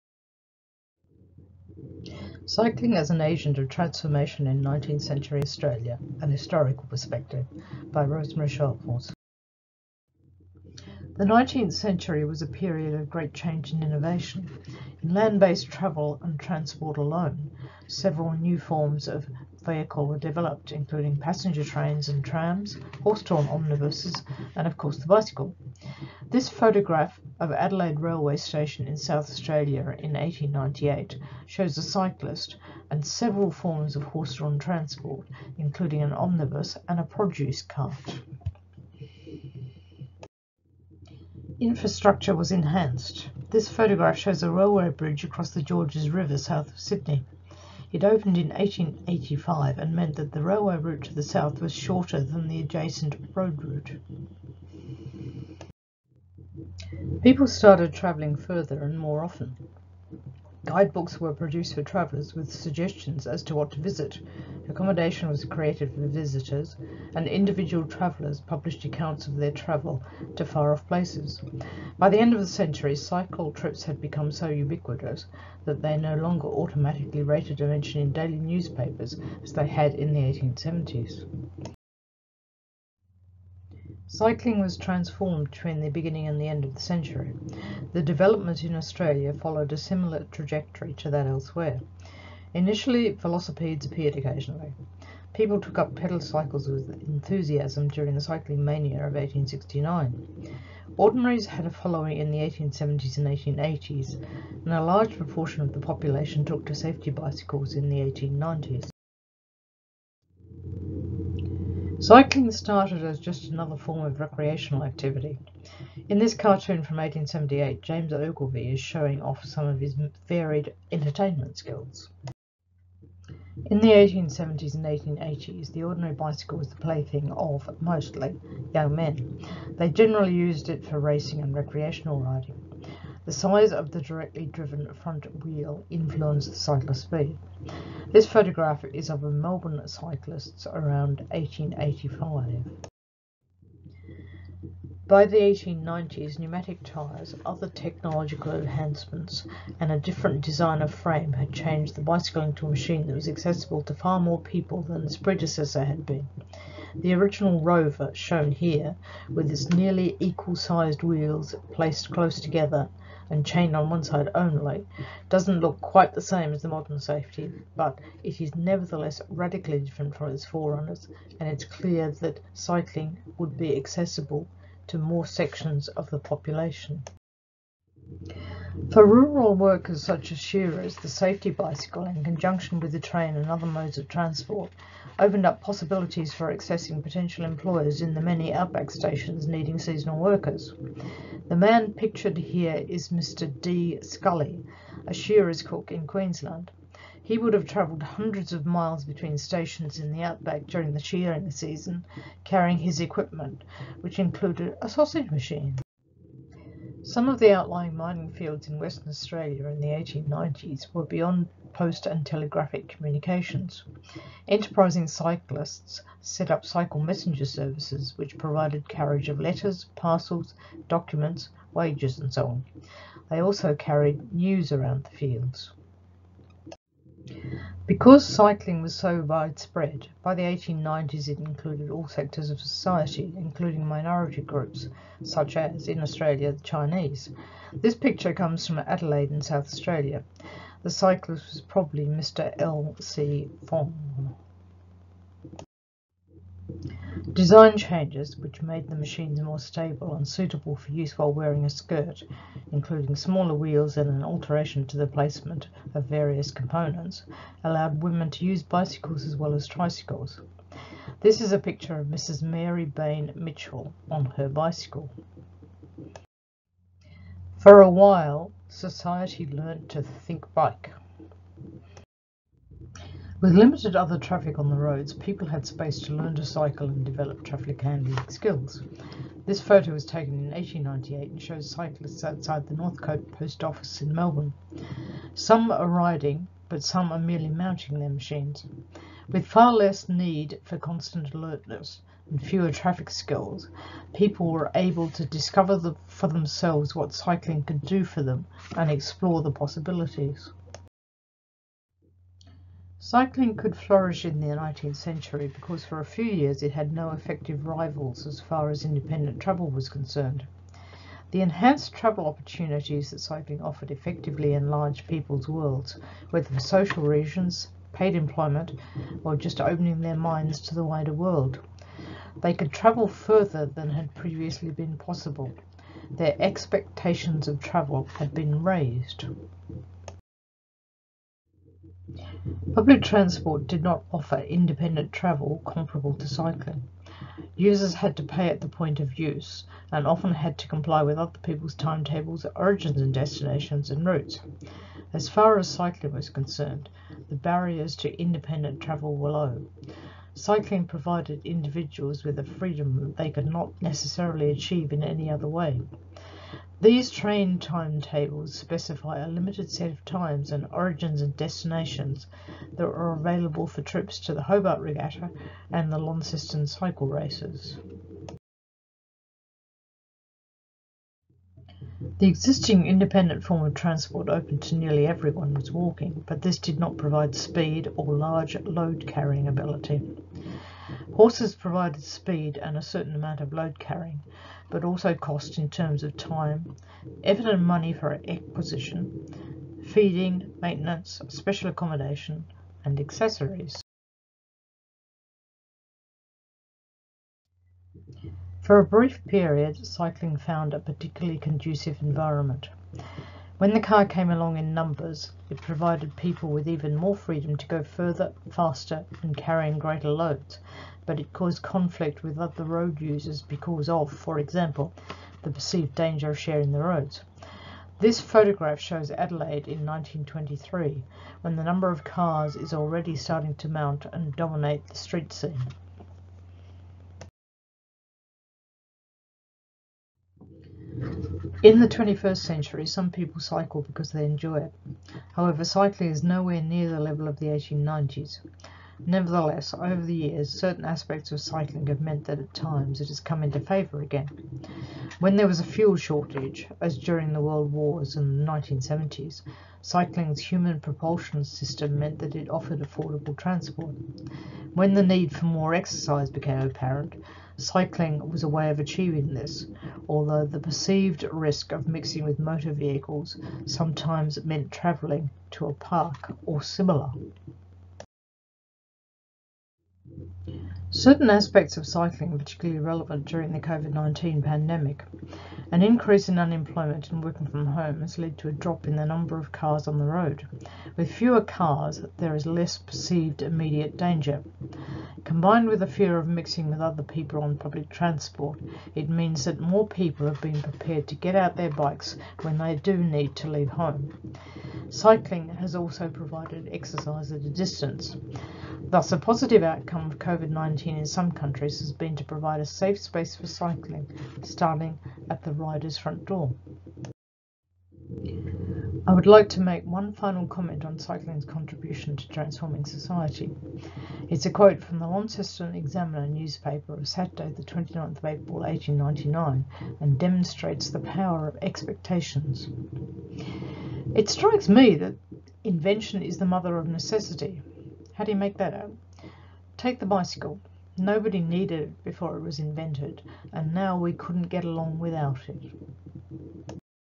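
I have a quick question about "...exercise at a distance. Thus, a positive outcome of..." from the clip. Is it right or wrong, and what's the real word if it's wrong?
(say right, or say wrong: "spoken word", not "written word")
right.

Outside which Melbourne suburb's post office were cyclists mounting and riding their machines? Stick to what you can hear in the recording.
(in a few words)
Northcote.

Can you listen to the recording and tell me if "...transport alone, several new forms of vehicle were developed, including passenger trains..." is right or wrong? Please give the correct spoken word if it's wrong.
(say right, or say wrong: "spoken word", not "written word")
right.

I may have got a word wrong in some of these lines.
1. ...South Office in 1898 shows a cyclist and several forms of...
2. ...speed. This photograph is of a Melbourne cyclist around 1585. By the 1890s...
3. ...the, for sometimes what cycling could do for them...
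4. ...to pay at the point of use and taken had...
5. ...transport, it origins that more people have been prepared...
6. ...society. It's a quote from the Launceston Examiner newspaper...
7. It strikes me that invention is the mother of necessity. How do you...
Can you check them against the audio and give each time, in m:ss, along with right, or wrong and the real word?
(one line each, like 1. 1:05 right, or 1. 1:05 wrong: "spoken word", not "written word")
1. 0:28 wrong: "Australia", not "Office"
2. 2:17 wrong: "1885", not "1585"
3. 4:55 wrong: "themselves", not "sometimes"
4. 5:38 wrong: "often", not "taken"
5. 8:07 wrong: "means", not "origins"
6. 8:32 right
7. 8:44 right.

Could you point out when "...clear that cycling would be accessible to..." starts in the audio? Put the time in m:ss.
2:51.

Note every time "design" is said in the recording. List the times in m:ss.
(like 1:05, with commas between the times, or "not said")
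2:30, 4:07.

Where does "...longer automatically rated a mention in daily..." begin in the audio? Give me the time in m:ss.
1:16.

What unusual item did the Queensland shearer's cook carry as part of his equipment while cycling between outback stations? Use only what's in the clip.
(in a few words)
A sausage machine.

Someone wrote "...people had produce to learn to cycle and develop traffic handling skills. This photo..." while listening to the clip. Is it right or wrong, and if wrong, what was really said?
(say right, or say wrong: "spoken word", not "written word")
wrong: "space", not "produce".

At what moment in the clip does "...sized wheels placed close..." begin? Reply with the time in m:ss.
2:40.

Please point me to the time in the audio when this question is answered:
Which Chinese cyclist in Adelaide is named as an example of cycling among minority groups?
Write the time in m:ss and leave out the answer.
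4:02.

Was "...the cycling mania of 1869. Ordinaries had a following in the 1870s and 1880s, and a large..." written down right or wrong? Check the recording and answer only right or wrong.
right.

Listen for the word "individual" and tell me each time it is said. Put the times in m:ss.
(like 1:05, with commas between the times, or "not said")
1:07, 5:51.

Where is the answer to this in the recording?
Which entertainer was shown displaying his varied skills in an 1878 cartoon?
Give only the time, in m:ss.
1:57.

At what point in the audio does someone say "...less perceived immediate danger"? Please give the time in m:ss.
8:02.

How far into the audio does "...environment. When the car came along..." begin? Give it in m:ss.
6:42.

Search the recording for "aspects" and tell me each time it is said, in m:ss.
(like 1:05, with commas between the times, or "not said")
7:20, 7:51.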